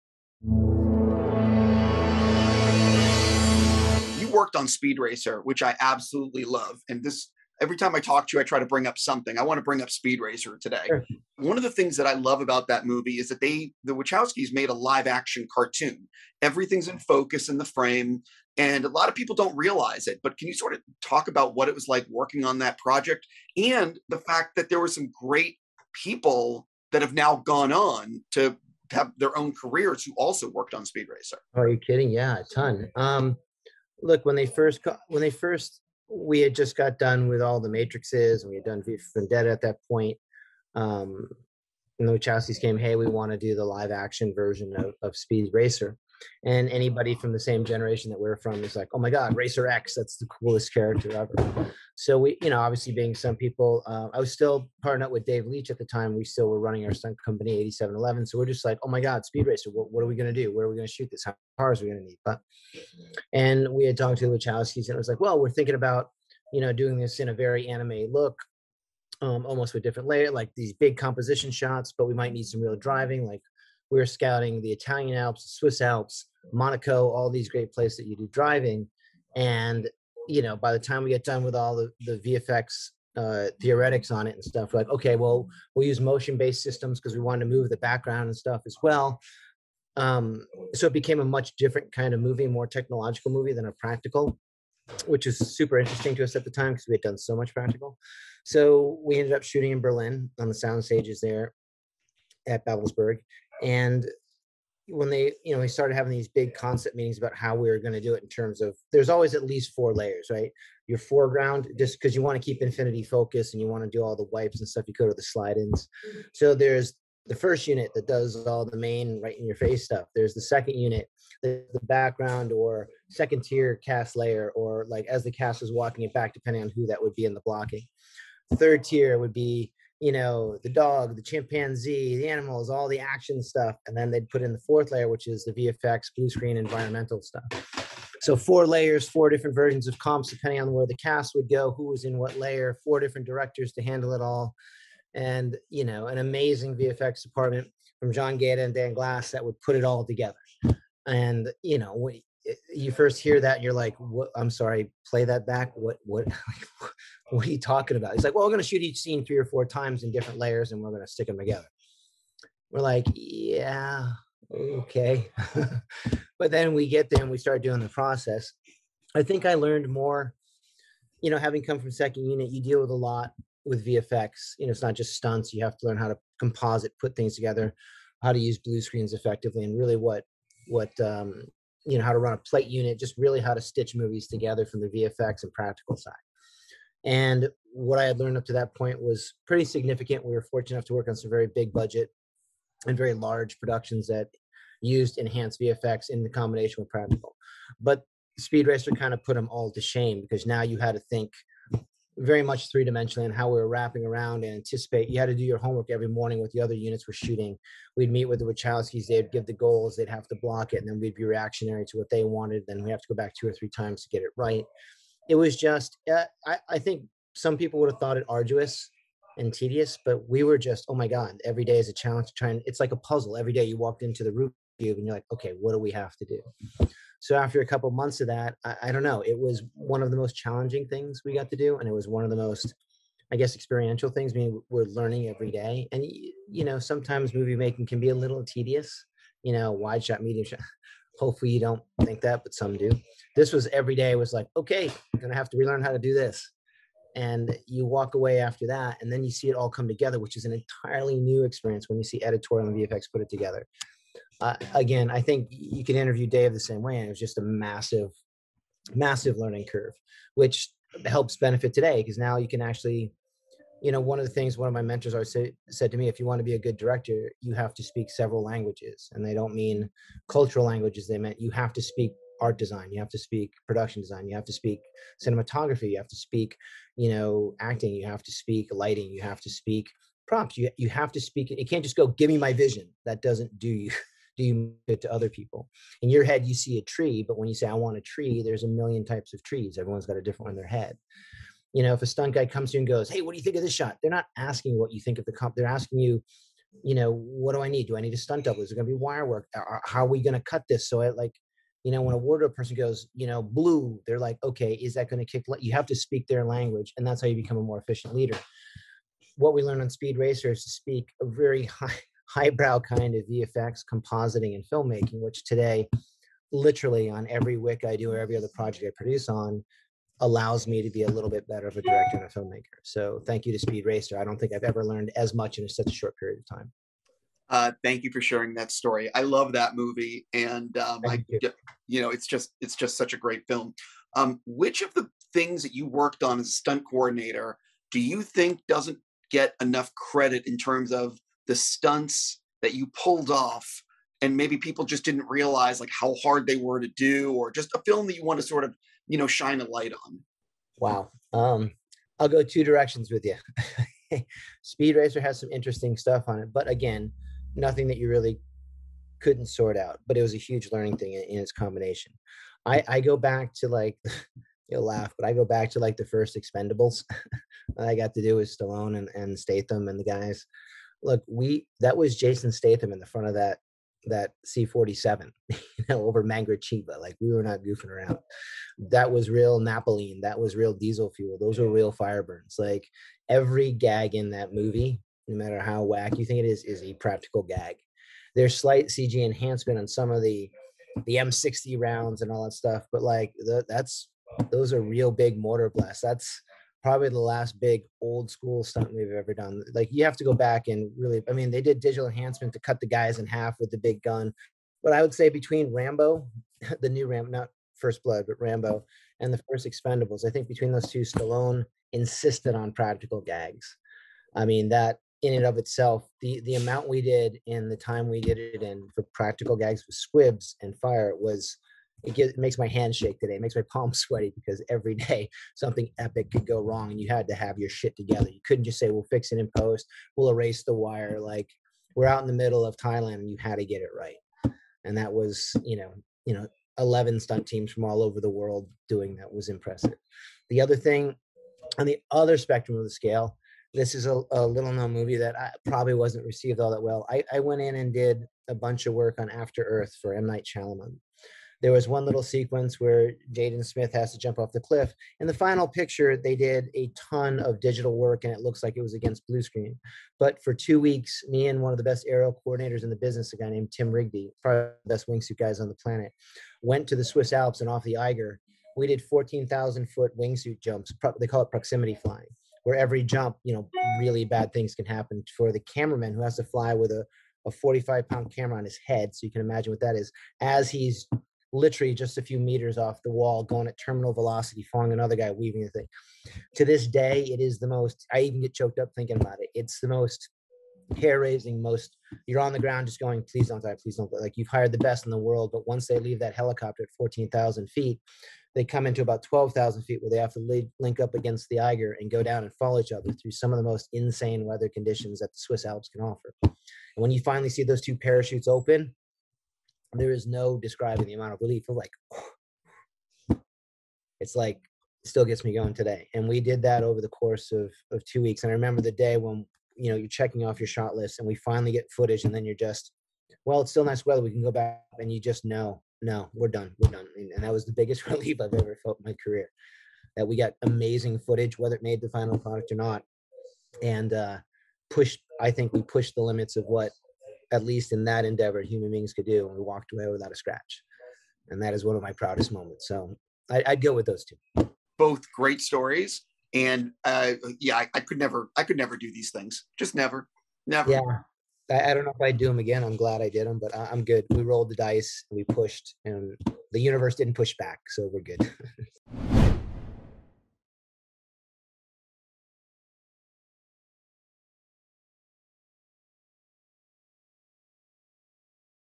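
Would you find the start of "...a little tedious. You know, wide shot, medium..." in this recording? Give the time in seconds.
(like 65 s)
238 s.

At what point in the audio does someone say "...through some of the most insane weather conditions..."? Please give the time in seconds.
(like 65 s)
503 s.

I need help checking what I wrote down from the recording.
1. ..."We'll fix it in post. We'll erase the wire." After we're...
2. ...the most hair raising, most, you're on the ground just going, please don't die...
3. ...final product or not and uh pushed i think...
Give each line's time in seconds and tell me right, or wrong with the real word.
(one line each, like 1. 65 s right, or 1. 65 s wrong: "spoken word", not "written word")
1. 428 s wrong: "Like", not "After"
2. 489 s right
3. 532 s right.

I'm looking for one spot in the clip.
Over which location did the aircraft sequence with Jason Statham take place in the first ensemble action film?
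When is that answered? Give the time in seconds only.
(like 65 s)
376 s.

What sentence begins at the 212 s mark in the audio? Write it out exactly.
Then we have to go back two or three times to get it right.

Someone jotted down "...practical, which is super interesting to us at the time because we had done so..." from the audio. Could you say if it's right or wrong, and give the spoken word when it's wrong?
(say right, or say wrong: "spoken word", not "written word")
right.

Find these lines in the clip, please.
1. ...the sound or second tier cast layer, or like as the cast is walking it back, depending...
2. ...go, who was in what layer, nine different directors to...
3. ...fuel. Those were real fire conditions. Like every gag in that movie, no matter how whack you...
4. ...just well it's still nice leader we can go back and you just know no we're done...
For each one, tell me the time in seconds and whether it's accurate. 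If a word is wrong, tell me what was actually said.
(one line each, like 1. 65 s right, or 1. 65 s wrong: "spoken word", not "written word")
1. 121 s wrong: "background", not "sound"
2. 141 s wrong: "four", not "nine"
3. 381 s wrong: "burns", not "conditions"
4. 522 s wrong: "weather", not "leader".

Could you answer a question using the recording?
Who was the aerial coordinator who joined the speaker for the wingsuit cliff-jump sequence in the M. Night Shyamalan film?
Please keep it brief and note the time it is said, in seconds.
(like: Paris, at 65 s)
Tim Rigby, at 463 s.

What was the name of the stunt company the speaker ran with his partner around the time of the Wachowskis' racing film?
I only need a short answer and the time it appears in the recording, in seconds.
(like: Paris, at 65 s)
8711, at 57 s.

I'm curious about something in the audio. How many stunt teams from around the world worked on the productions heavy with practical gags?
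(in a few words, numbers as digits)
11.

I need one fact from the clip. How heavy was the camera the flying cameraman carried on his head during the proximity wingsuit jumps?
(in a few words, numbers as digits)
45 pounds.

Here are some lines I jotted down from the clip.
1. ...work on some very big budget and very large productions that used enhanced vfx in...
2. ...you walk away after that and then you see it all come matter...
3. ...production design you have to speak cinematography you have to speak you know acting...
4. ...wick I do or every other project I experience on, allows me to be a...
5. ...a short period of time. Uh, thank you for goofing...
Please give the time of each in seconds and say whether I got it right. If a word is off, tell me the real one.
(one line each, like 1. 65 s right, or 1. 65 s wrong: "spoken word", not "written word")
1. 190 s right
2. 247 s wrong: "together", not "matter"
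3. 273 s right
4. 317 s wrong: "produce", not "experience"
5. 325 s wrong: "sharing", not "goofing".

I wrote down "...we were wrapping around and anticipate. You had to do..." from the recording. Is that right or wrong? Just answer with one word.
right.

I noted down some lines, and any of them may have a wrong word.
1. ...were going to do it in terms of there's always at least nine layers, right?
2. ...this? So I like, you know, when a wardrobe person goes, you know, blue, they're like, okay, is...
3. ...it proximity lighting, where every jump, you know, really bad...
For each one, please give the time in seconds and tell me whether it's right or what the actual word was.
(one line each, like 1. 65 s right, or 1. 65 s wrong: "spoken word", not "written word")
1. 107 s wrong: "four", not "nine"
2. 300 s right
3. 471 s wrong: "flying", not "lighting".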